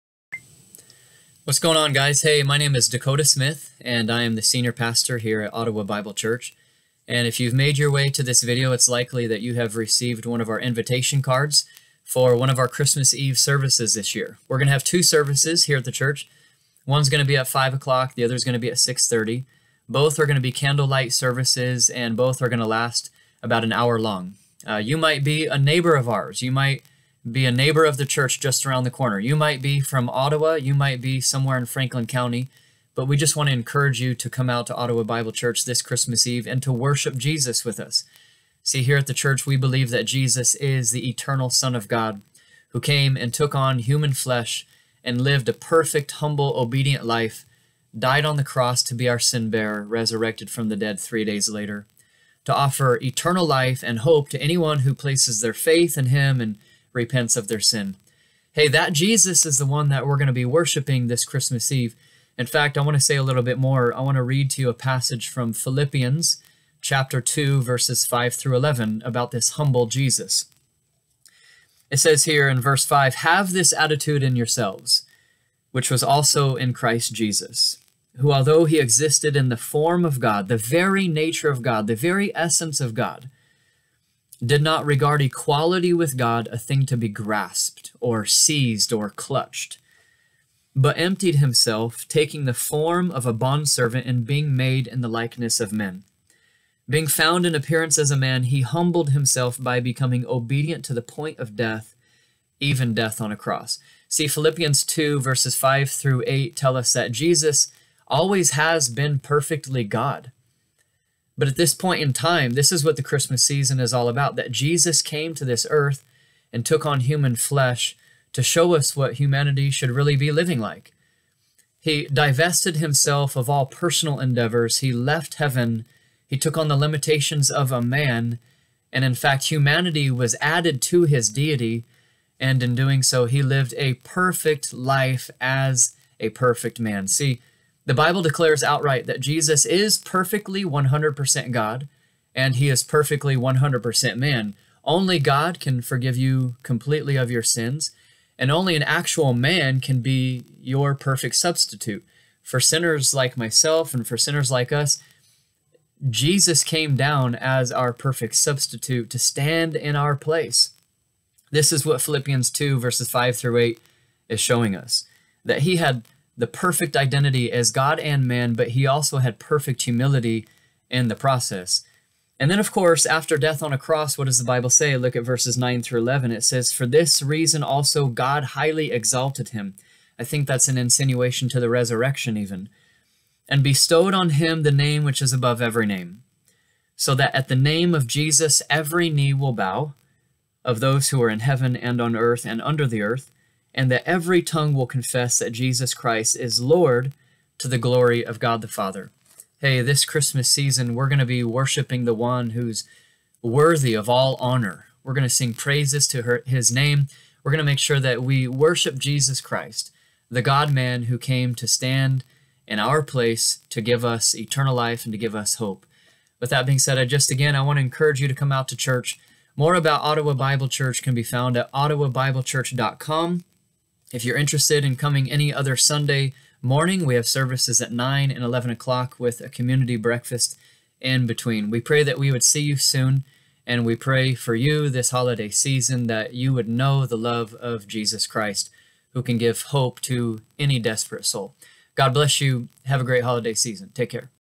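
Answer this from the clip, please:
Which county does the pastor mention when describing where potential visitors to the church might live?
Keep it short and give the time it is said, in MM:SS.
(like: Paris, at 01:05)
Franklin County, at 00:31.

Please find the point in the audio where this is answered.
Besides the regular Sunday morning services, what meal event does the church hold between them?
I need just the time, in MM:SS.
03:49.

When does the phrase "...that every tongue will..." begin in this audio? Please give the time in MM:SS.
03:13.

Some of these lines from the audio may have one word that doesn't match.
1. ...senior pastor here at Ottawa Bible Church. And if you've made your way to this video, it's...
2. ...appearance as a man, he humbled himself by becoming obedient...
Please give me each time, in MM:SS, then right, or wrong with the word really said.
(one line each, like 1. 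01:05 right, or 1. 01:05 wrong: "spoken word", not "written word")
1. 00:04 right
2. 01:37 right.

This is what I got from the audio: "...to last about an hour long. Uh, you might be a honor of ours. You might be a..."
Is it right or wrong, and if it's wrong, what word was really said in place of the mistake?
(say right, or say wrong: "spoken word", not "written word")
wrong: "neighbor", not "honor".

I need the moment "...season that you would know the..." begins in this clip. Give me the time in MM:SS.
03:55.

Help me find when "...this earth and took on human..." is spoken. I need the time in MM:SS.
01:55.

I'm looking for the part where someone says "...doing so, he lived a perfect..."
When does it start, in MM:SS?
02:12.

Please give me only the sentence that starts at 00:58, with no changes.
Hey, that Jesus is the one that we're going to be worshiping this Christmas Eve.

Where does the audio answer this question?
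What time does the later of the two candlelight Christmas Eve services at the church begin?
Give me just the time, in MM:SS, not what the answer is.
00:18.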